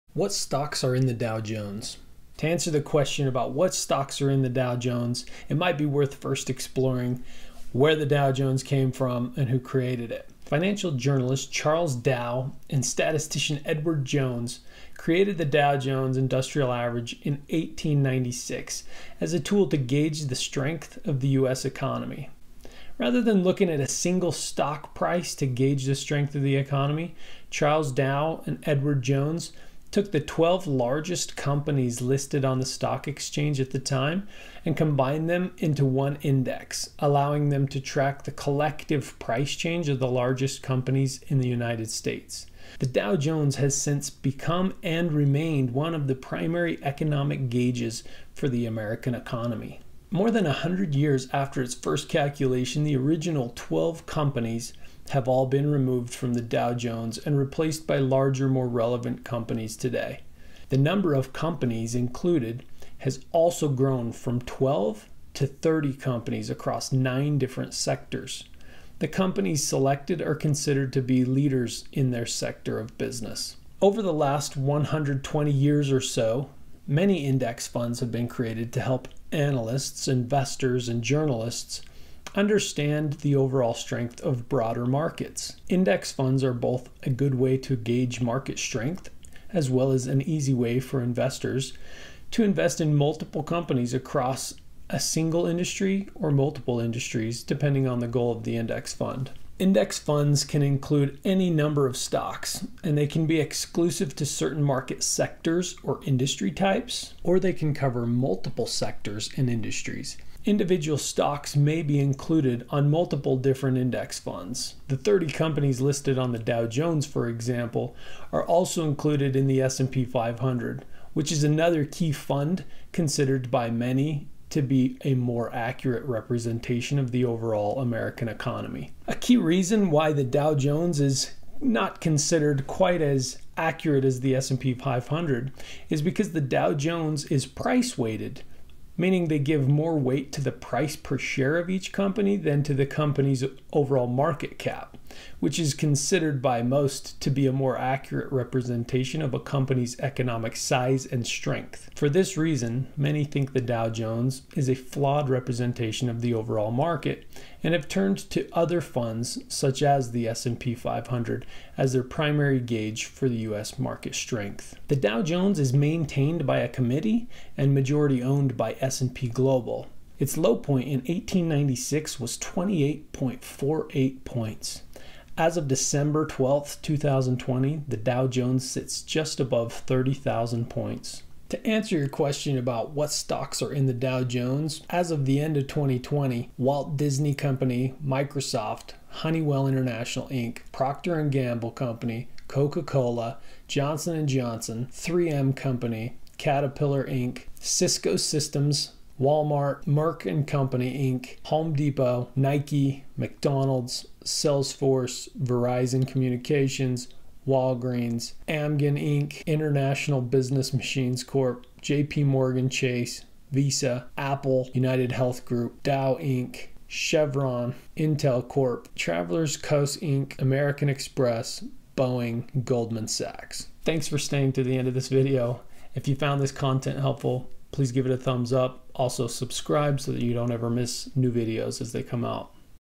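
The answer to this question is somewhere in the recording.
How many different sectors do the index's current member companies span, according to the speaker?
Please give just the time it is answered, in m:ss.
1:06.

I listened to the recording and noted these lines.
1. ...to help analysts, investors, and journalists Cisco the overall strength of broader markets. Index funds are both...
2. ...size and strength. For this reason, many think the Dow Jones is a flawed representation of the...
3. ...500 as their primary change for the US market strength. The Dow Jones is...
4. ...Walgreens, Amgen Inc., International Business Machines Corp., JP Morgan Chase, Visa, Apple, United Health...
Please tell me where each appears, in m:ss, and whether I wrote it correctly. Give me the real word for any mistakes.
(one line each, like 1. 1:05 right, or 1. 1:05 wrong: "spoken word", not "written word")
1. 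1:18 wrong: "Understand", not "Cisco"
2. 2:30 right
3. 2:40 wrong: "gauge", not "change"
4. 3:27 right.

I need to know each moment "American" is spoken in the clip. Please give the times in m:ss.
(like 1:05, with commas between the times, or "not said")
0:48, 2:07, 3:40.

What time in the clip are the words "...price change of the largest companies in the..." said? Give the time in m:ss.
0:39.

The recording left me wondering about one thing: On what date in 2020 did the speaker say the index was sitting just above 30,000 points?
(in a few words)
December 12th.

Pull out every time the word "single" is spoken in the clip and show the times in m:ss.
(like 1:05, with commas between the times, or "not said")
0:23, 1:34.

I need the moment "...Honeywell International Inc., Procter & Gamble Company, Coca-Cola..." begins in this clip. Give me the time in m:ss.
3:09.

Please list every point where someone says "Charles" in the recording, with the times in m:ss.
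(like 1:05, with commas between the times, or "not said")
0:11, 0:27.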